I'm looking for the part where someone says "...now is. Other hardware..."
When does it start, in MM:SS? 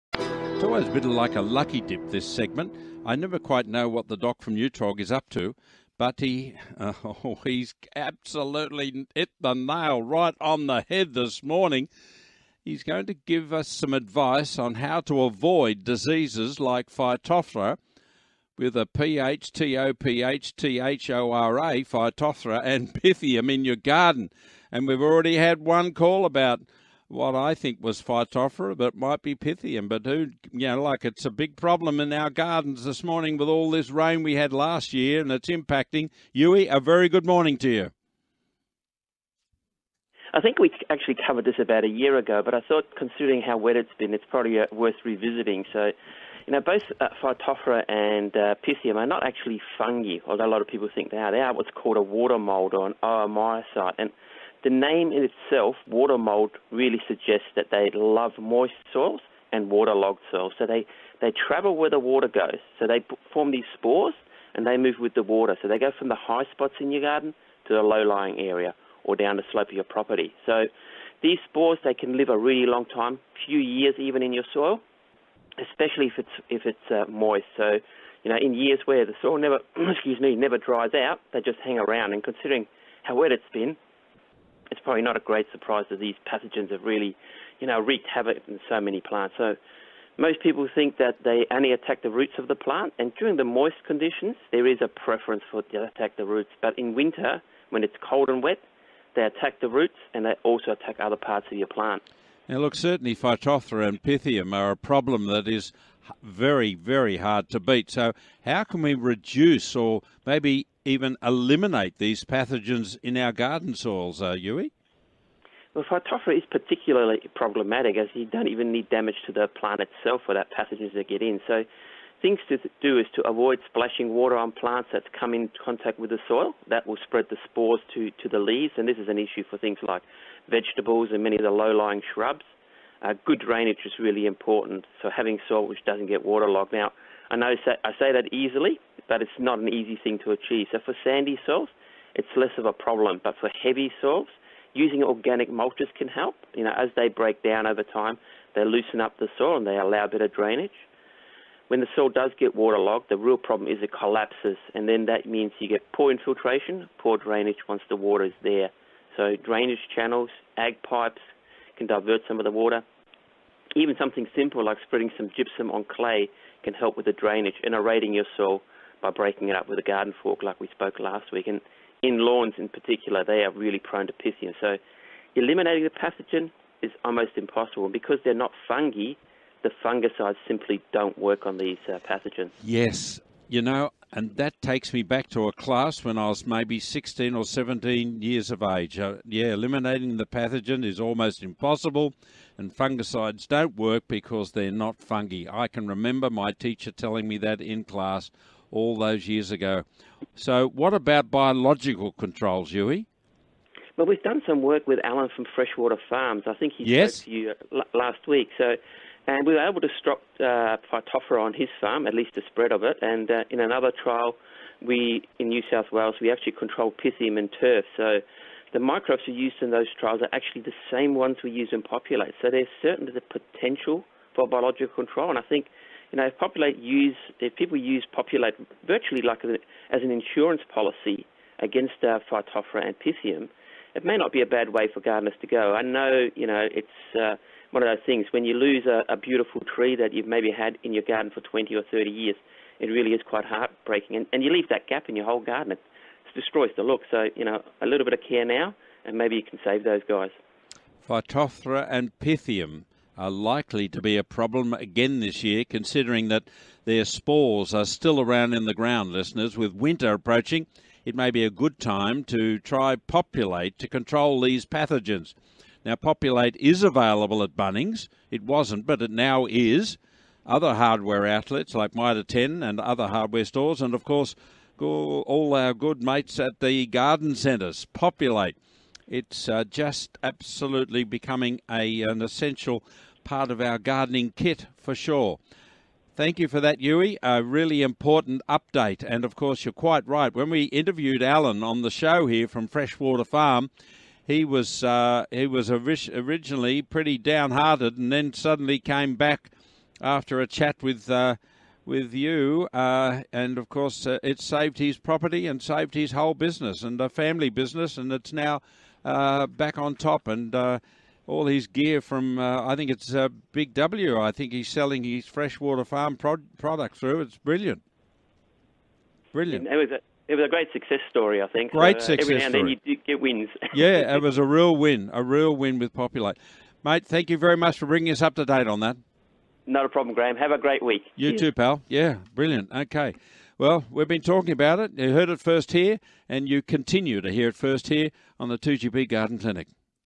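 04:29.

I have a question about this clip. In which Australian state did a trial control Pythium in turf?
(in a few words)
New South Wales.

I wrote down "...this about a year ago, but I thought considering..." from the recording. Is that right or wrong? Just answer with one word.
right.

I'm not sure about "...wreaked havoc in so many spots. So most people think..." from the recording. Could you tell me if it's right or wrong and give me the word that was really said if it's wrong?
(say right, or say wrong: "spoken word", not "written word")
wrong: "plants", not "spots".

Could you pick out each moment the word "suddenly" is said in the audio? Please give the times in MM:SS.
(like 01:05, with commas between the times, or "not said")
04:58.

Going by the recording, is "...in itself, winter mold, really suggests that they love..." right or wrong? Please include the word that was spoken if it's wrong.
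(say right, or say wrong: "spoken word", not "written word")
wrong: "water", not "winter".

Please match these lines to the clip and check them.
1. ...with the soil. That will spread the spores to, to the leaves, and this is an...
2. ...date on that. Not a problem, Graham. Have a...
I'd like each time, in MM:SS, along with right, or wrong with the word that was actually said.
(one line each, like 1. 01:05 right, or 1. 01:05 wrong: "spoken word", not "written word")
1. 02:05 right
2. 05:28 right.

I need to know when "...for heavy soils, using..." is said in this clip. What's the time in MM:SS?
02:23.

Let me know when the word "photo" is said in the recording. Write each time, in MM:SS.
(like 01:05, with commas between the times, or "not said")
not said.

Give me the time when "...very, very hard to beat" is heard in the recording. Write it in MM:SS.
01:46.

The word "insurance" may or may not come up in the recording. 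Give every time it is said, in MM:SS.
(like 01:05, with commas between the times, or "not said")
03:50.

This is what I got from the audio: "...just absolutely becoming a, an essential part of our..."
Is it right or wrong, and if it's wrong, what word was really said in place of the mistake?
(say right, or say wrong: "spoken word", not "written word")
right.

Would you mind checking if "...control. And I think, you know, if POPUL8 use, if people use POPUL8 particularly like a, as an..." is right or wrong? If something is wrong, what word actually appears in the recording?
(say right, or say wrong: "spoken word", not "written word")
wrong: "virtually", not "particularly".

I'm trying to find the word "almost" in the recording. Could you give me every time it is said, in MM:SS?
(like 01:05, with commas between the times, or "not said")
02:57, 03:10.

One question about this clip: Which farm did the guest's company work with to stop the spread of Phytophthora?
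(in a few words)
Freshwater Farms.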